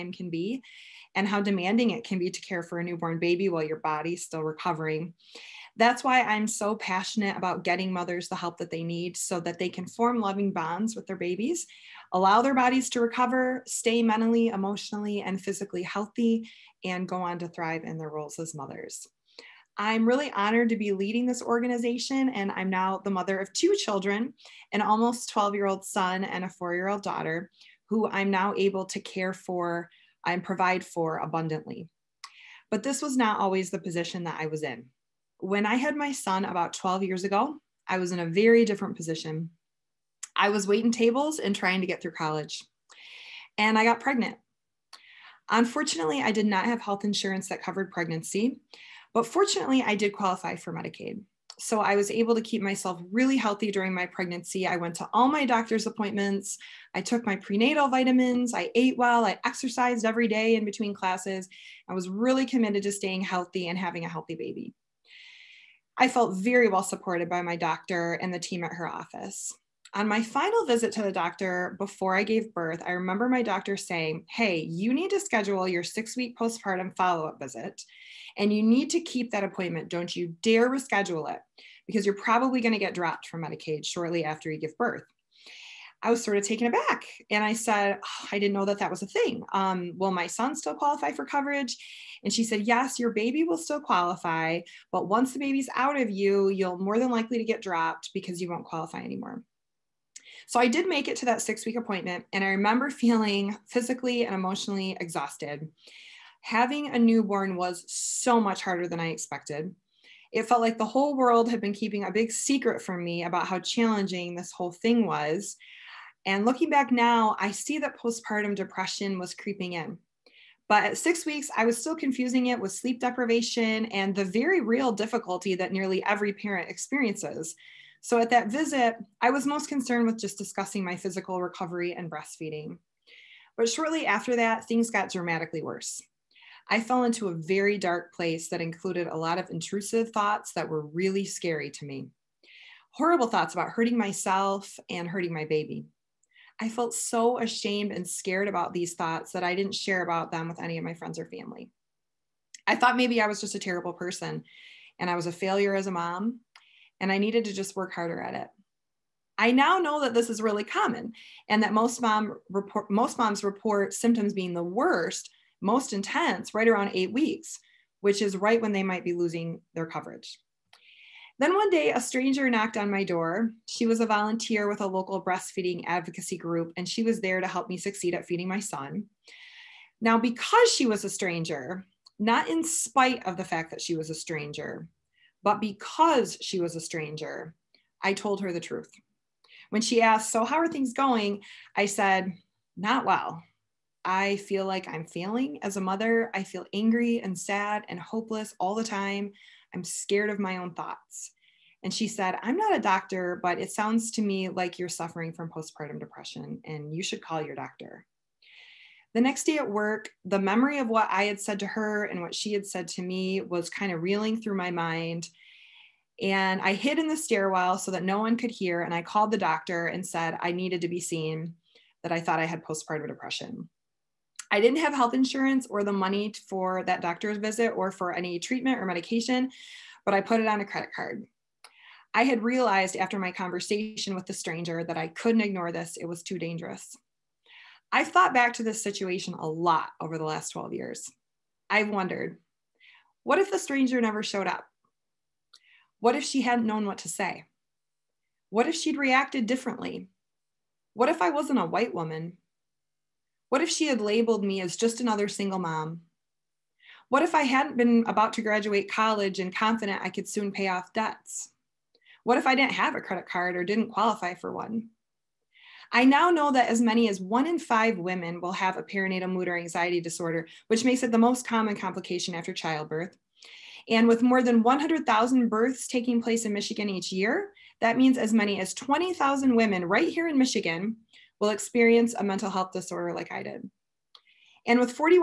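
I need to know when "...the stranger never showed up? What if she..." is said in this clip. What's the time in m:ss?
4:03.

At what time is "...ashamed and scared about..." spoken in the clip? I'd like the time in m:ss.
2:27.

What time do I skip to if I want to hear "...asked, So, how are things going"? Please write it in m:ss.
3:10.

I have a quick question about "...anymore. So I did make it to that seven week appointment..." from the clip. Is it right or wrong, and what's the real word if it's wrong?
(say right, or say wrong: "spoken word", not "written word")
wrong: "six", not "seven".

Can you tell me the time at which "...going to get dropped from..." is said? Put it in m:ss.
1:22.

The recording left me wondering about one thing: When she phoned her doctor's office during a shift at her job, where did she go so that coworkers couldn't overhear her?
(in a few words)
the stairwell.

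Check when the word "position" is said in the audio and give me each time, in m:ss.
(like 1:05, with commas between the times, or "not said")
0:33, 0:38.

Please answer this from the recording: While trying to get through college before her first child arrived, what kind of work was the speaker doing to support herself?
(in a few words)
waiting tables.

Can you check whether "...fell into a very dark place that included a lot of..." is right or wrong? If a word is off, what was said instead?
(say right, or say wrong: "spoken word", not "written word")
right.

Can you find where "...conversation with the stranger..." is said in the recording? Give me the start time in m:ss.
3:53.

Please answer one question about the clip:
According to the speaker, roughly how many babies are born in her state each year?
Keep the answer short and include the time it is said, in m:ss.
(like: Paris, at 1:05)
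100,000, at 4:34.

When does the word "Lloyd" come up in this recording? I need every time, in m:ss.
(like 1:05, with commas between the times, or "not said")
not said.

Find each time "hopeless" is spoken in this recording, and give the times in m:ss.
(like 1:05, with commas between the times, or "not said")
3:17.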